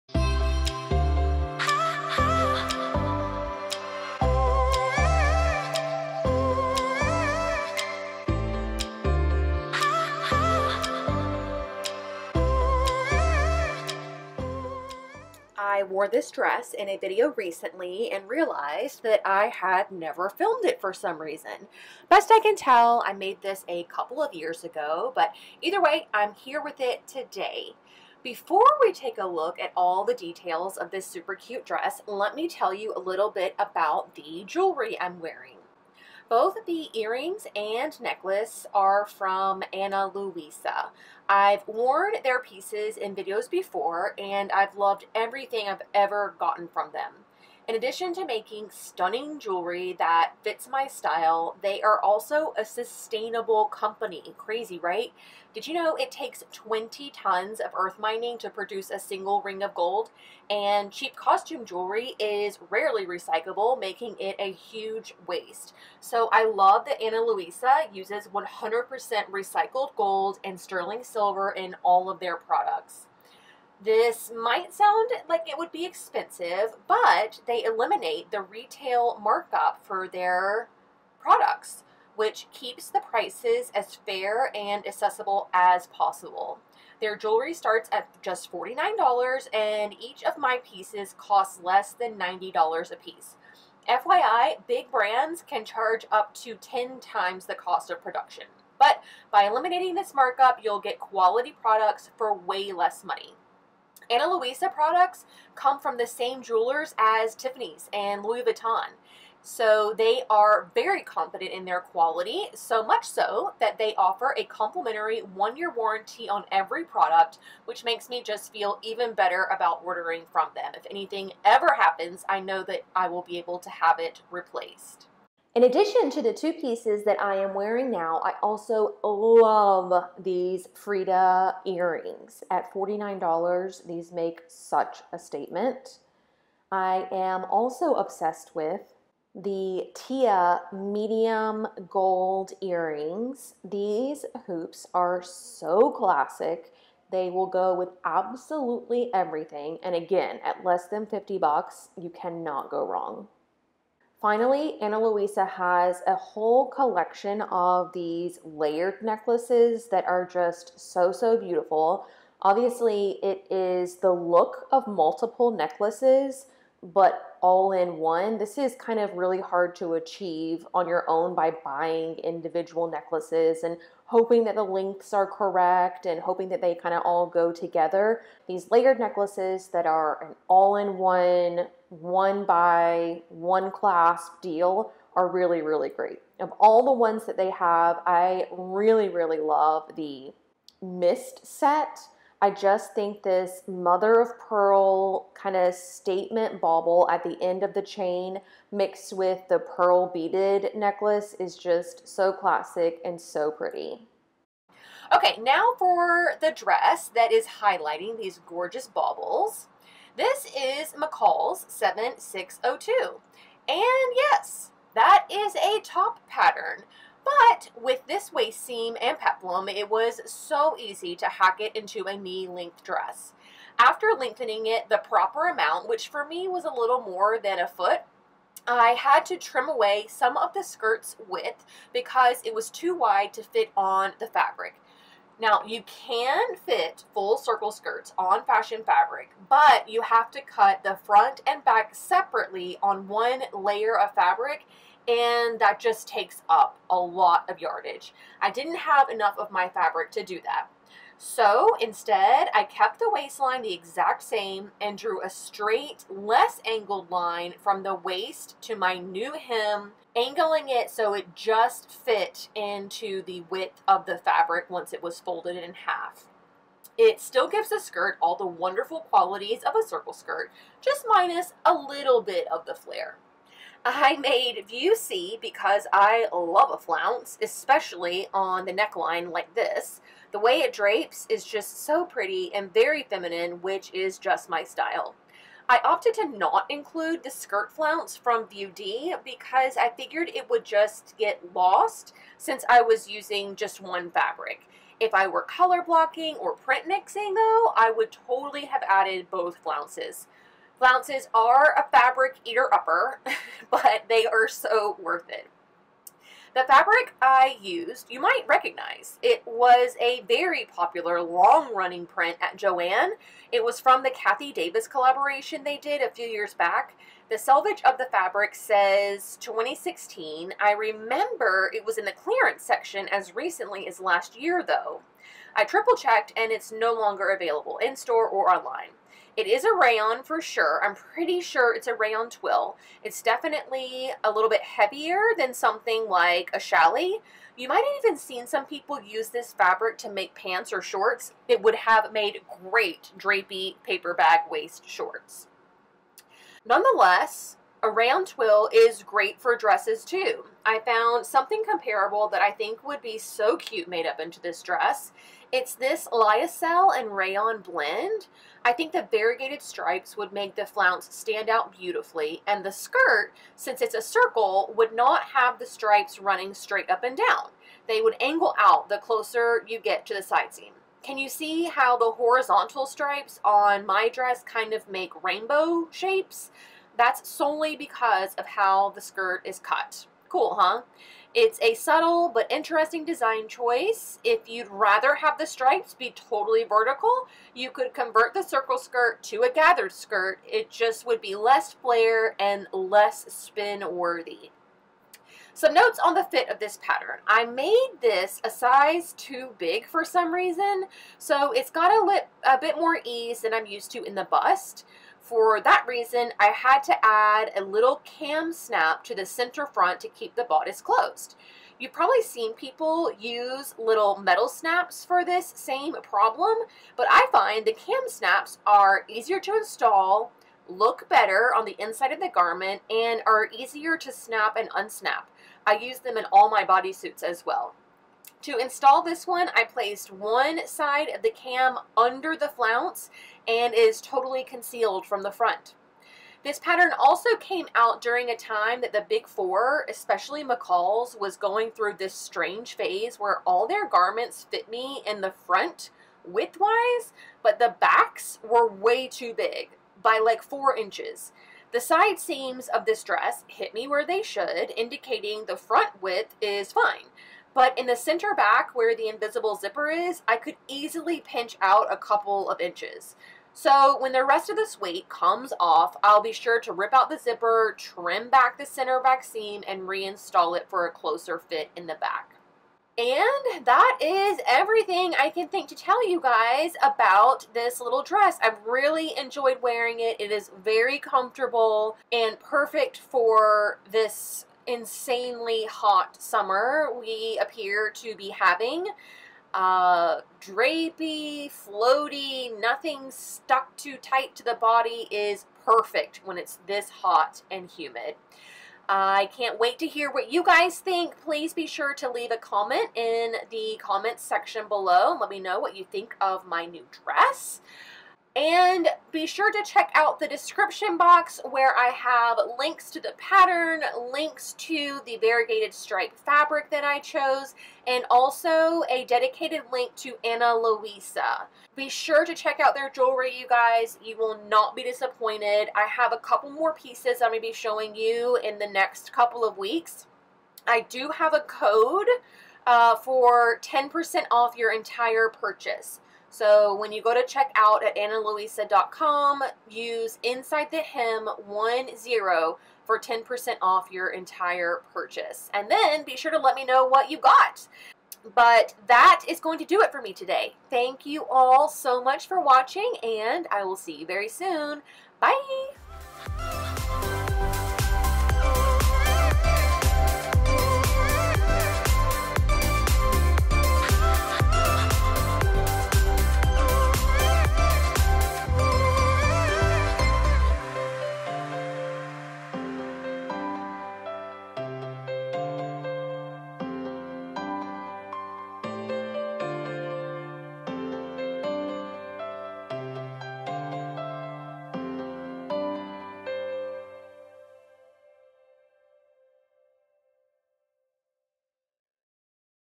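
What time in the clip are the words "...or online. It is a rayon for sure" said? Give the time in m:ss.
5:28.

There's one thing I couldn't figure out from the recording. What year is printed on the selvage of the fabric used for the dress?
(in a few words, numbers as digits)
2016.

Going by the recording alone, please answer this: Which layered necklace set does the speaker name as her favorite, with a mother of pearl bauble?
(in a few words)
Mist.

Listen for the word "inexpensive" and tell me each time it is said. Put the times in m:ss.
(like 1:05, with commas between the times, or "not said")
not said.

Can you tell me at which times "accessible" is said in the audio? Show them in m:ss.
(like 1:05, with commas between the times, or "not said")
1:24.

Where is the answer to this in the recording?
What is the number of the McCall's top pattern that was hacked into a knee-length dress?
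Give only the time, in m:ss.
3:31.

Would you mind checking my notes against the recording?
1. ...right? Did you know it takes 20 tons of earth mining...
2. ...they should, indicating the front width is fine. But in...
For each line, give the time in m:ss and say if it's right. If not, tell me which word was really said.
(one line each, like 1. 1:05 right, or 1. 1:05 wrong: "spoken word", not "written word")
1. 0:54 right
2. 7:34 right.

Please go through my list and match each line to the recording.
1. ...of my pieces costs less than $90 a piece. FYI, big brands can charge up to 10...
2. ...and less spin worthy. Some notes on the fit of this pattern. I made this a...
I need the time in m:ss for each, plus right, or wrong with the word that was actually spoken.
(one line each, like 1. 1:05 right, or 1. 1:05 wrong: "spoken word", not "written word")
1. 1:30 right
2. 6:32 right.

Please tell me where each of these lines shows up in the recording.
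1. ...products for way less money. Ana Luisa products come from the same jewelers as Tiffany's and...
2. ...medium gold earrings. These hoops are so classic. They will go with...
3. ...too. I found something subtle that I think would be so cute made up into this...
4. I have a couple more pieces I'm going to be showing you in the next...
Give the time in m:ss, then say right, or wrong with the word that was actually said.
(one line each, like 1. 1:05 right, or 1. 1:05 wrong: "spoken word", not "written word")
1. 1:41 right
2. 2:20 right
3. 5:50 wrong: "comparable", not "subtle"
4. 8:45 right.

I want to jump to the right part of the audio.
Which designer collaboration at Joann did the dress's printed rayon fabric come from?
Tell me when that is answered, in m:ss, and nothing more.
5:14.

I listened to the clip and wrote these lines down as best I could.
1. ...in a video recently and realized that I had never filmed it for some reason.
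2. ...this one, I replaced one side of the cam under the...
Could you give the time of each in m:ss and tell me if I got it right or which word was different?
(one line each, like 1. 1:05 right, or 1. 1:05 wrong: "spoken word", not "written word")
1. 0:16 right
2. 7:09 wrong: "placed", not "replaced".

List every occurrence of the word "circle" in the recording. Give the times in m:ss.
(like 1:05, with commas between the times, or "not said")
3:57, 4:29, 6:04, 6:28.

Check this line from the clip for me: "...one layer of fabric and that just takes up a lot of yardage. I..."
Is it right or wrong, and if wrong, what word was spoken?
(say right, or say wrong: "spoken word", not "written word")
right.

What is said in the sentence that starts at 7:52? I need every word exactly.
And that is everything I can think to tell you guys about this little dress.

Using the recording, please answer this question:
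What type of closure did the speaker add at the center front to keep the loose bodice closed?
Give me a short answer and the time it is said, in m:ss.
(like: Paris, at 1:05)
cam snap, at 6:48.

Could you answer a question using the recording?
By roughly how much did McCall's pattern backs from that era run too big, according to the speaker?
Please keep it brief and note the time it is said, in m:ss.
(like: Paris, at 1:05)
4 inches, at 7:30.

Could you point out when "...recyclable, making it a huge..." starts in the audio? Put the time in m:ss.
1:03.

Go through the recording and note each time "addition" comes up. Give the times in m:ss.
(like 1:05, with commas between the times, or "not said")
0:47, 2:05.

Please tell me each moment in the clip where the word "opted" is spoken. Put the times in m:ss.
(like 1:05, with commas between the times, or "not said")
4:45.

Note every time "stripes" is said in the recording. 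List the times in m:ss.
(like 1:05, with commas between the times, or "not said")
5:59, 6:05, 6:12, 6:25, 8:35.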